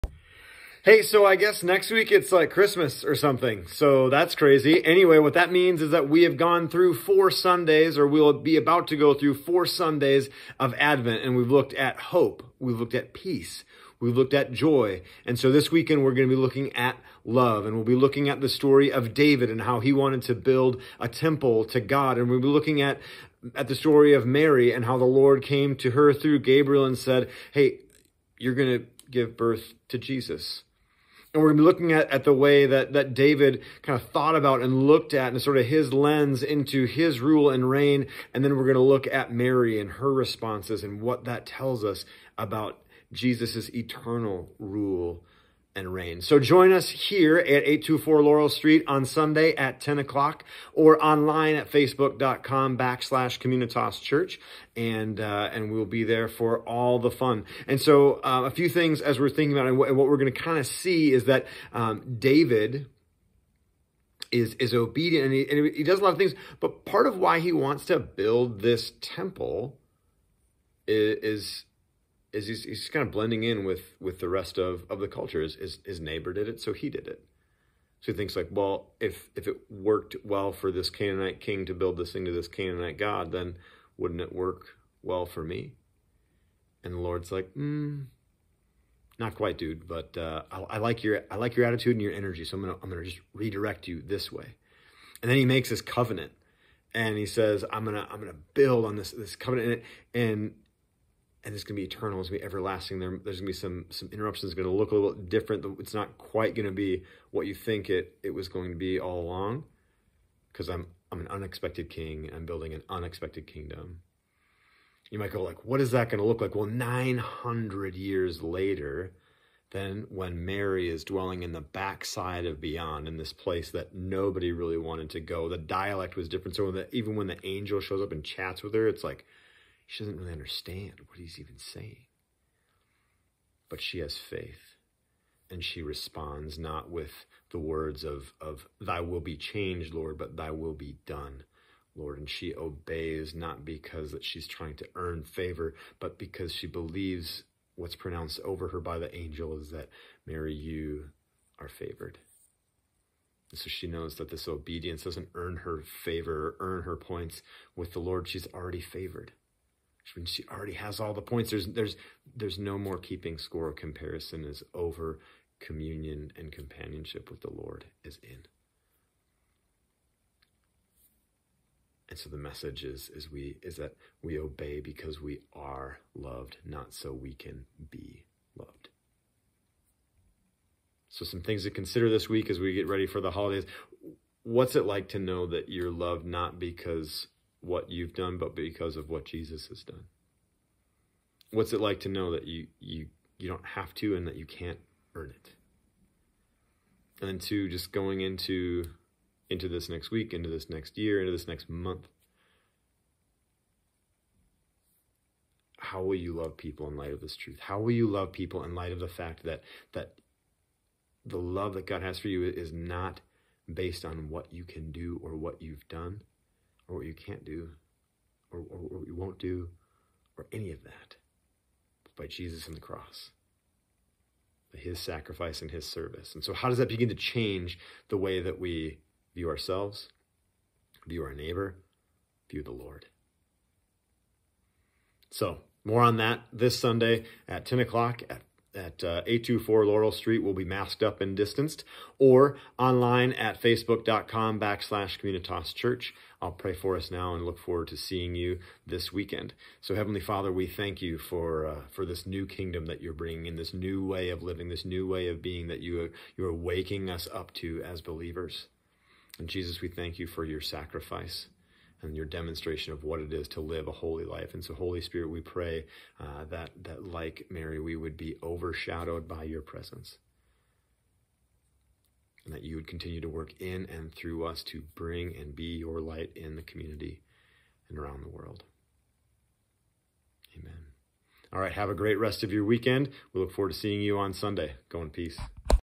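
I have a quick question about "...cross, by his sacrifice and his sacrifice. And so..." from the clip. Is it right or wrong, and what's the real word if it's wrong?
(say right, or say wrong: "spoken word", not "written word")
wrong: "service", not "sacrifice".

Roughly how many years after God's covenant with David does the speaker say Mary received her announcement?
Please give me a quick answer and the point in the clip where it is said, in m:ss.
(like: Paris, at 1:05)
900, at 1:56.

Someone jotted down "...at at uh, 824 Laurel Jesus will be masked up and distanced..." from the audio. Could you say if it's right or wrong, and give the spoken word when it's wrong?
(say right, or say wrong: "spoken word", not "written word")
wrong: "Street", not "Jesus".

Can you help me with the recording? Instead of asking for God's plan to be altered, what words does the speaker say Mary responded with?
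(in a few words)
Thy will be done.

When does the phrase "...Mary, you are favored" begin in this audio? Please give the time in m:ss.
2:30.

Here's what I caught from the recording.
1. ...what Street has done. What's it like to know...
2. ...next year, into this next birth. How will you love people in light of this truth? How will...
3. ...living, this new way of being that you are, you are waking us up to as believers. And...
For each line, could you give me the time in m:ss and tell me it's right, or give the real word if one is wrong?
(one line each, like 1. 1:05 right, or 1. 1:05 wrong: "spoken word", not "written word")
1. 3:09 wrong: "Jesus", not "Street"
2. 3:20 wrong: "month", not "birth"
3. 4:14 right.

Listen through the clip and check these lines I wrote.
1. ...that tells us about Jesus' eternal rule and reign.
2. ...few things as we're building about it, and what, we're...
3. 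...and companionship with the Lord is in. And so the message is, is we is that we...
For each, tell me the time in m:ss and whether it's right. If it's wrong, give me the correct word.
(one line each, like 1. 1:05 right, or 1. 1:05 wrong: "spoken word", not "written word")
1. 0:41 right
2. 0:58 wrong: "thinking", not "building"
3. 2:46 right.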